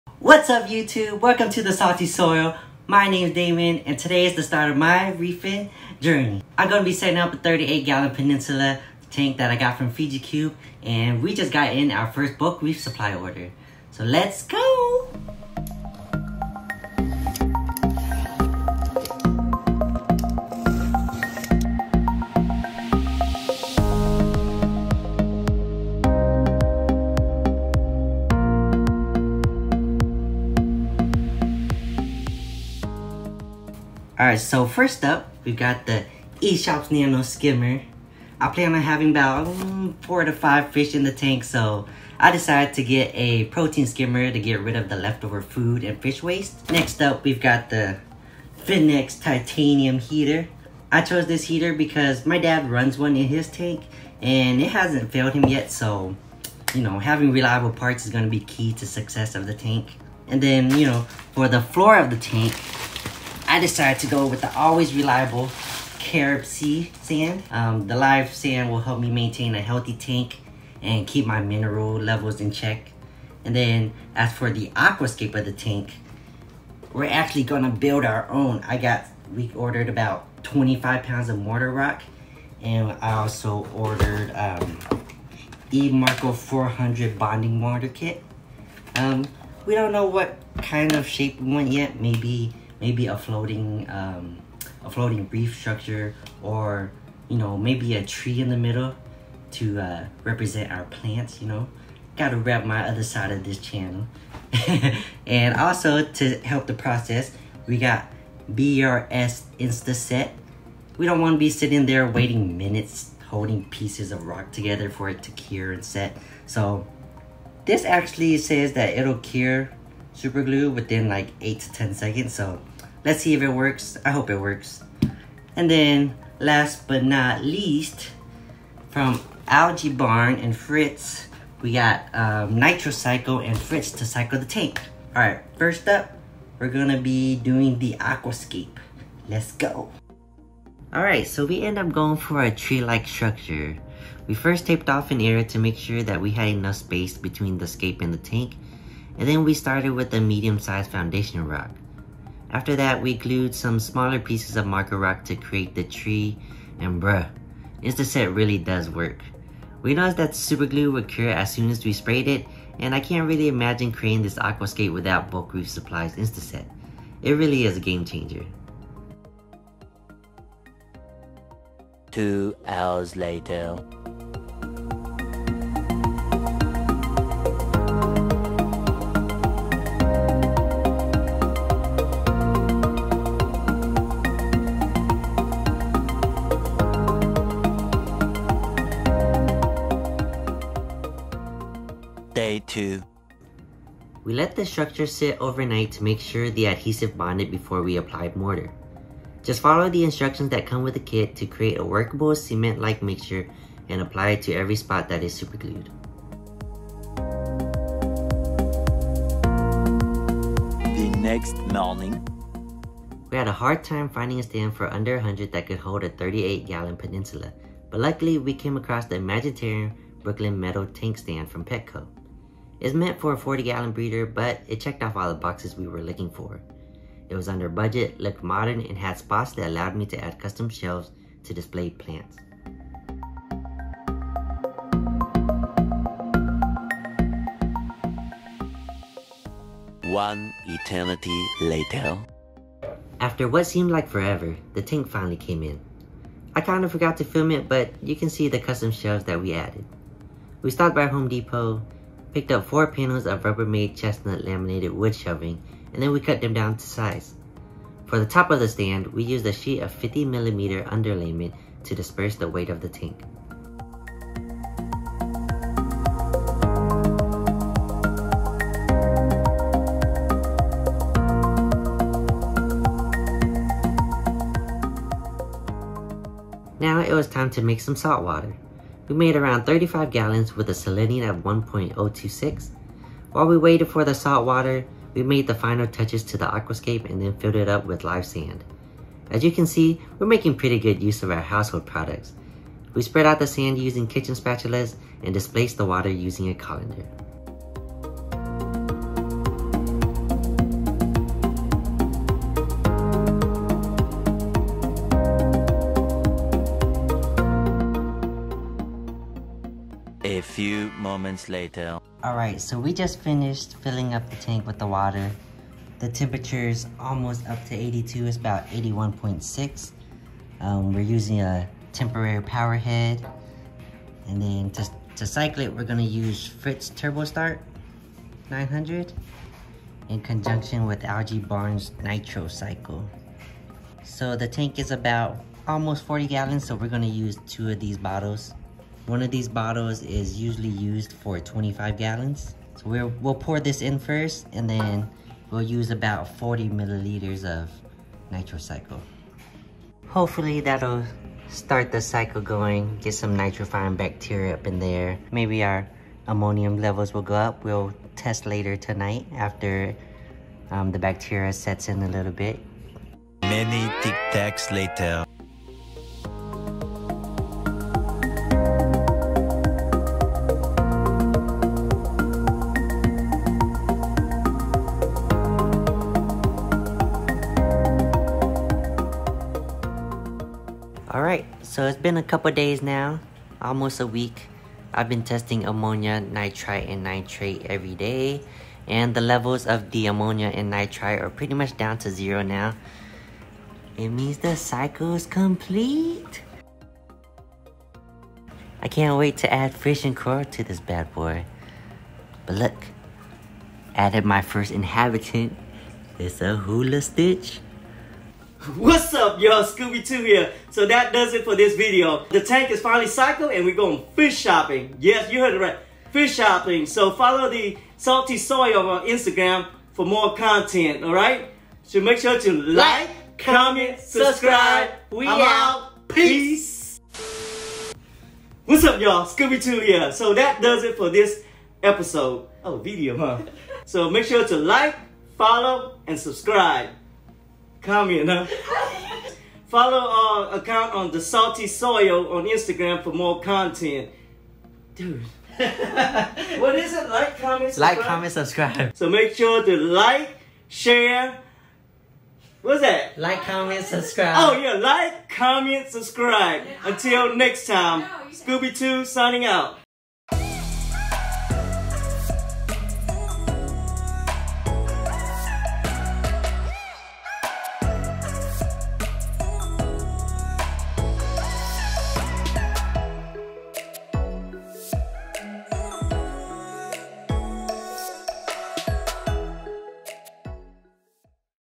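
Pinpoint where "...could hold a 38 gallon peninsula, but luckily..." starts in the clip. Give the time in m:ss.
3:35.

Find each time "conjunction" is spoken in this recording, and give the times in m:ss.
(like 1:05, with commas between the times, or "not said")
5:30.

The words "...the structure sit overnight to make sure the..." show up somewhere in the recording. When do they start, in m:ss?
3:14.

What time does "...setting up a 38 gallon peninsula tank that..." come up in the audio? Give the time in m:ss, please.
0:06.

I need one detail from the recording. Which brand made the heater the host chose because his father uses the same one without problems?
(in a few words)
Finnex.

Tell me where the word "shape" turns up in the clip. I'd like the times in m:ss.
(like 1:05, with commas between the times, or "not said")
1:31.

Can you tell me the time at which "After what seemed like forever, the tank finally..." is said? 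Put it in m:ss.
4:03.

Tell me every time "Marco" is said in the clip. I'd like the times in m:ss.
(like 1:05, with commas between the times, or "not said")
1:21, 1:25, 2:34.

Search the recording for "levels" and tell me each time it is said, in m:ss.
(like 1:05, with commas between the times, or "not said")
1:11, 5:56, 6:29.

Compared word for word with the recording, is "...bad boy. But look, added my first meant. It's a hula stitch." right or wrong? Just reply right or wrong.
wrong.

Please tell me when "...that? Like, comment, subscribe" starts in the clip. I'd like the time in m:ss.
7:32.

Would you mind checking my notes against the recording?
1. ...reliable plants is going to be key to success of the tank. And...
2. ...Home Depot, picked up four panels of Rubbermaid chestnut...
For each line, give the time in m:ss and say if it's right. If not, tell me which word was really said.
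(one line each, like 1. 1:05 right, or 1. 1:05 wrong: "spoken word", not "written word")
1. 0:57 wrong: "parts", not "plants"
2. 4:11 right.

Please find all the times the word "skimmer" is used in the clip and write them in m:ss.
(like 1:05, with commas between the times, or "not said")
0:37, 0:43.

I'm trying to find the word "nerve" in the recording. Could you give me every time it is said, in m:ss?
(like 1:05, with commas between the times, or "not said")
not said.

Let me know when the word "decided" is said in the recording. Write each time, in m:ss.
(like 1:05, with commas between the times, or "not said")
0:42, 1:03.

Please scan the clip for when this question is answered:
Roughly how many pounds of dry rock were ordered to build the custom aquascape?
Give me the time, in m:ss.
1:20.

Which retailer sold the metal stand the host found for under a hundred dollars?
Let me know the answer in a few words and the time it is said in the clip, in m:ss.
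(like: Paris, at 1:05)
Petco, at 3:41.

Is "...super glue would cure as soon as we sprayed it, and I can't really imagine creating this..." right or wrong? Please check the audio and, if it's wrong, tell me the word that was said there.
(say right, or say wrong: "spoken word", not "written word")
right.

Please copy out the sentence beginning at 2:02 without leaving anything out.
So let's see if it works.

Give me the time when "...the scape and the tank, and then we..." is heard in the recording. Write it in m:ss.
2:27.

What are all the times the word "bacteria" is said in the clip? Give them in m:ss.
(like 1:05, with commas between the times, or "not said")
5:53, 6:00.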